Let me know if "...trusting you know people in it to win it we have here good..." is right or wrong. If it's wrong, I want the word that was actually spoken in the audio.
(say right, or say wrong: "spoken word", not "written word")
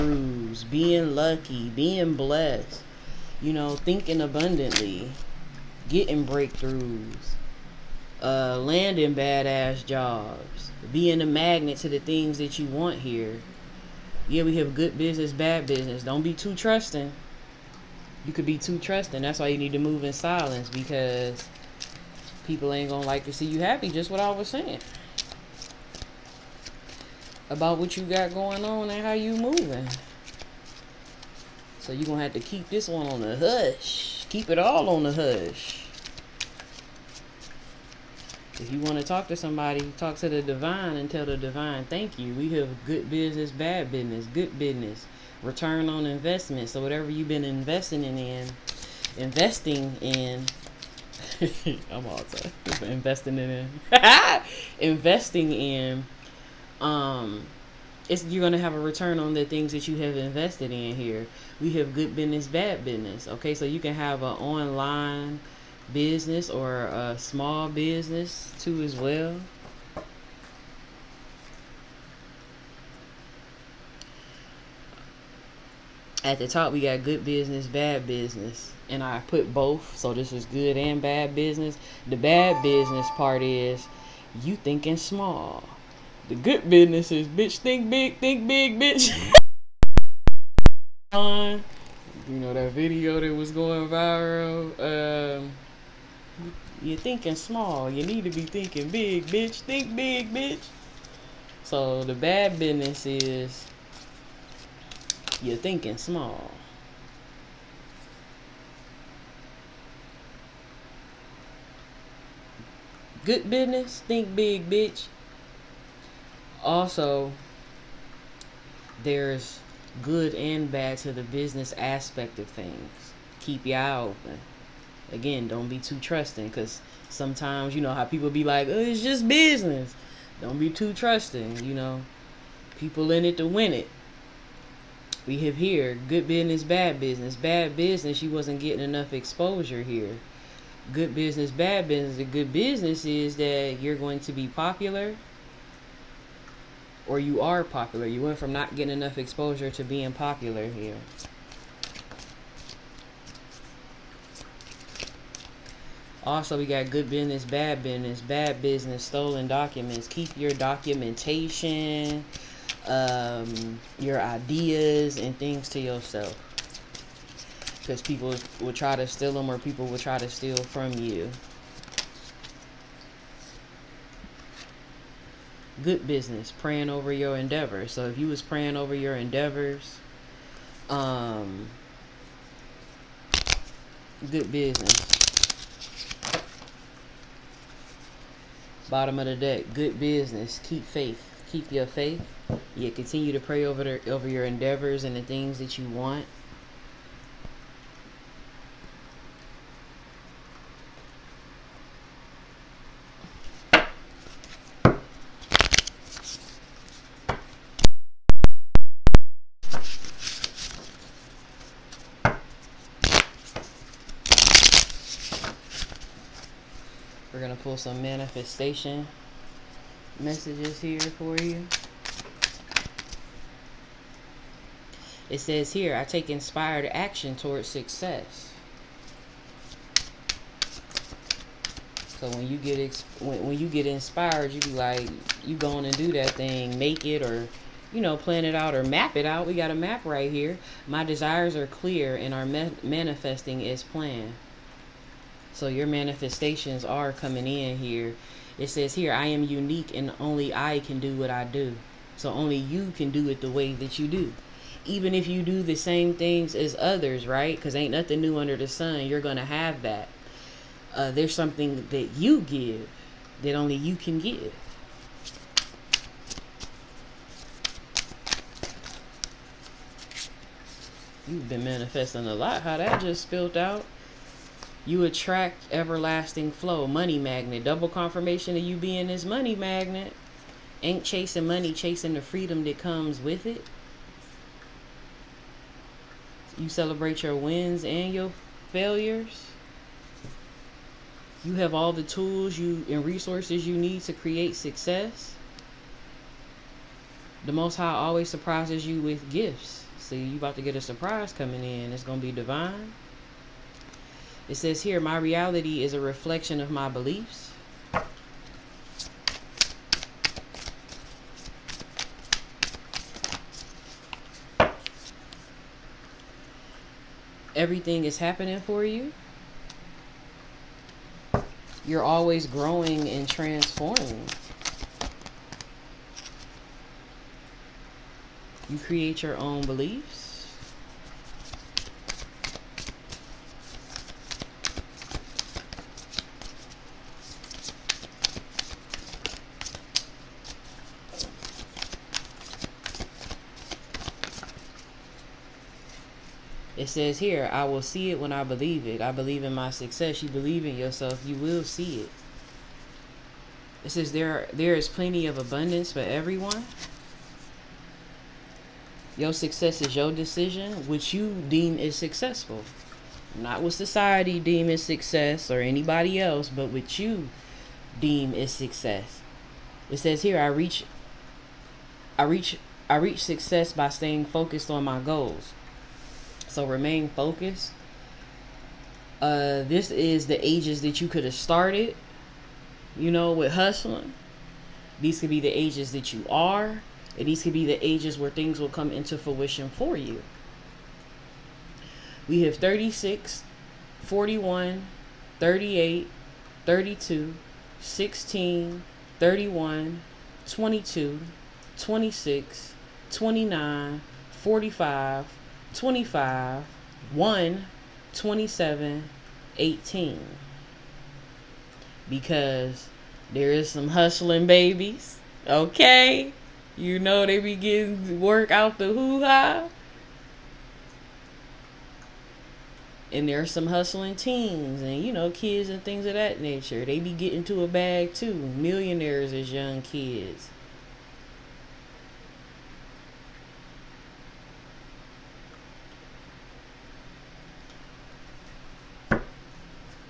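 right.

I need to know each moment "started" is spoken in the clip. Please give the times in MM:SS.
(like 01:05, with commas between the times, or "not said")
06:21.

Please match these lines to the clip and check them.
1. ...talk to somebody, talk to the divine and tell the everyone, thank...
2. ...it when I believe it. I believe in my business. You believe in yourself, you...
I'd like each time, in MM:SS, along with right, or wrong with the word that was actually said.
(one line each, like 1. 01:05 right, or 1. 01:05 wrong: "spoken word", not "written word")
1. 00:39 wrong: "divine", not "everyone"
2. 05:48 wrong: "success", not "business".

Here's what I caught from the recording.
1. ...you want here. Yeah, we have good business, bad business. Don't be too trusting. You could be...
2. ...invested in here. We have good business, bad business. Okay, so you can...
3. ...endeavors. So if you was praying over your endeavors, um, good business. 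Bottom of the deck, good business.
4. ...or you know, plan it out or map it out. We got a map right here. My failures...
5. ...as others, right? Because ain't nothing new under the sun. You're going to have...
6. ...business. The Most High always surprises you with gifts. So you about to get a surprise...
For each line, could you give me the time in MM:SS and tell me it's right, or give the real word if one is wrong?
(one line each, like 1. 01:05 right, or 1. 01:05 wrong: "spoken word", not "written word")
1. 00:12 right
2. 01:00 right
3. 02:57 right
4. 03:57 wrong: "desires", not "failures"
5. 04:16 right
6. 04:54 wrong: "success", not "business".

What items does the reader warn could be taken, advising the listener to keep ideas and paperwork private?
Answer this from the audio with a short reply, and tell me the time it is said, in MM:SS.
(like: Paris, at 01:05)
Stolen documents, at 02:39.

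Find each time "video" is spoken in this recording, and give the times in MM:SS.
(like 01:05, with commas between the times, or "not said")
01:32.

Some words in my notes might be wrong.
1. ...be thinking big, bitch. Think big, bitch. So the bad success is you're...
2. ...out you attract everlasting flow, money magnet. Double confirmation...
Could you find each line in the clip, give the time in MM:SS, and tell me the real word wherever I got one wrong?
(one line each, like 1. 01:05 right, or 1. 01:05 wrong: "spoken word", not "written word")
1. 01:38 wrong: "business", not "success"
2. 04:33 right.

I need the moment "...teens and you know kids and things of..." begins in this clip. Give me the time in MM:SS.
07:04.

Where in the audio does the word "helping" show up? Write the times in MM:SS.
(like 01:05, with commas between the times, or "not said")
not said.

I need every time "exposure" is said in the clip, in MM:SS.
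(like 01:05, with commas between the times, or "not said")
02:19, 02:29.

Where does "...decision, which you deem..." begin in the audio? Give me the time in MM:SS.
06:00.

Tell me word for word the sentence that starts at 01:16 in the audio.
At the top, we got good business, bad business.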